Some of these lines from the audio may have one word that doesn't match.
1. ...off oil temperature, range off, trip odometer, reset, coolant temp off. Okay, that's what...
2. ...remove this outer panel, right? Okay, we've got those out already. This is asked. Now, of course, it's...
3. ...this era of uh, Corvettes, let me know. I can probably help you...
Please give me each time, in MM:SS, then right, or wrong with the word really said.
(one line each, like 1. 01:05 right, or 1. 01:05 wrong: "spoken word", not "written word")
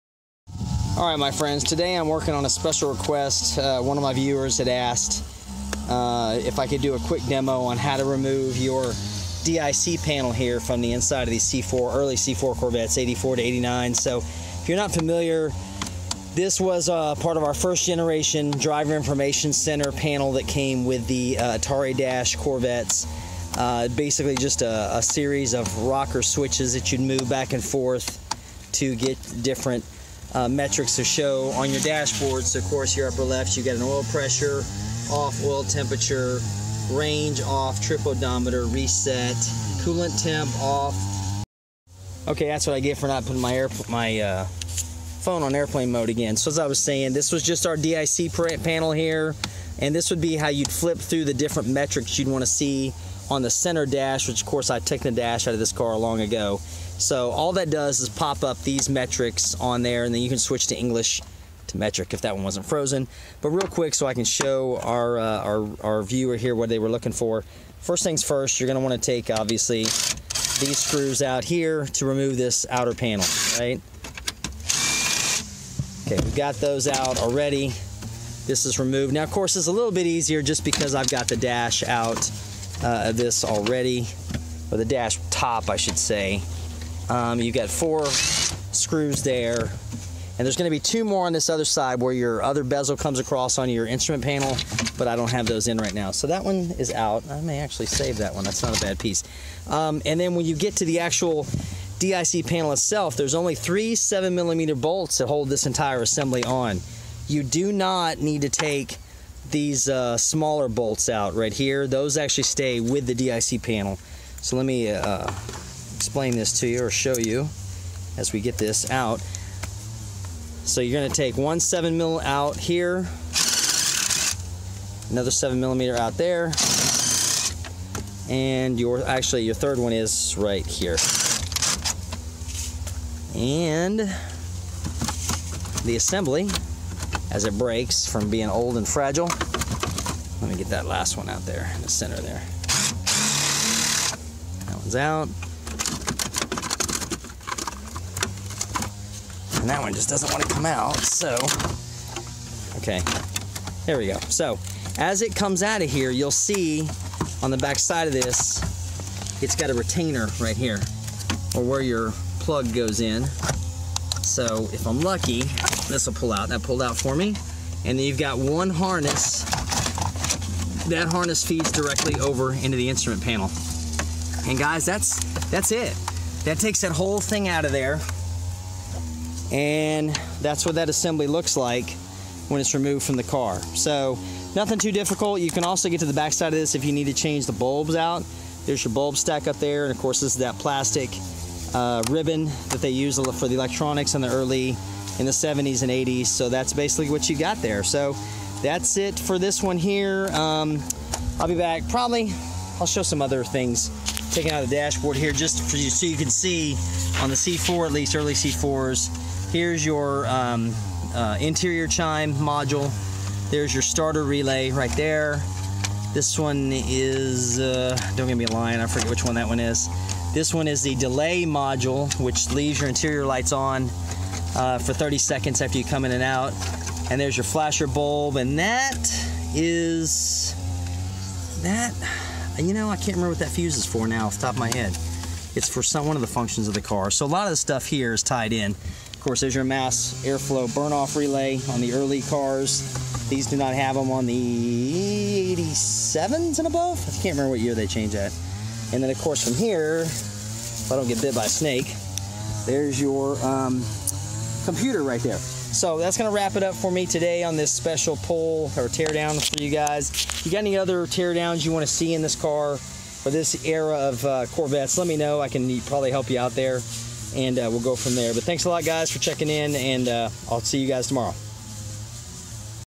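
1. 00:35 right
2. 01:12 wrong: "removed", not "asked"
3. 04:23 right.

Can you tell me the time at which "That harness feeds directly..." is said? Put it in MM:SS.
02:50.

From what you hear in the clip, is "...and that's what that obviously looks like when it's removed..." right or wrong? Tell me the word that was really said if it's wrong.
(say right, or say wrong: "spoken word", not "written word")
wrong: "assembly", not "obviously".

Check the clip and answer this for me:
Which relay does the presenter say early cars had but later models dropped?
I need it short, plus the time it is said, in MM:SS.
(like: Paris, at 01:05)
mass airflow burn-off relay, at 03:59.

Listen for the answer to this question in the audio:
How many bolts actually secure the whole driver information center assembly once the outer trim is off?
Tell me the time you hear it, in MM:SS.
01:43.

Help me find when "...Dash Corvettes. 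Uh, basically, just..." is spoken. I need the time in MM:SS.
00:21.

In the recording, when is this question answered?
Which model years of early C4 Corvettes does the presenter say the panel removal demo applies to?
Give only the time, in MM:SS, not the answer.
00:12.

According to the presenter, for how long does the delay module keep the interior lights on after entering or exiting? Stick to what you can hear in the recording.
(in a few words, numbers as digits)
30 seconds.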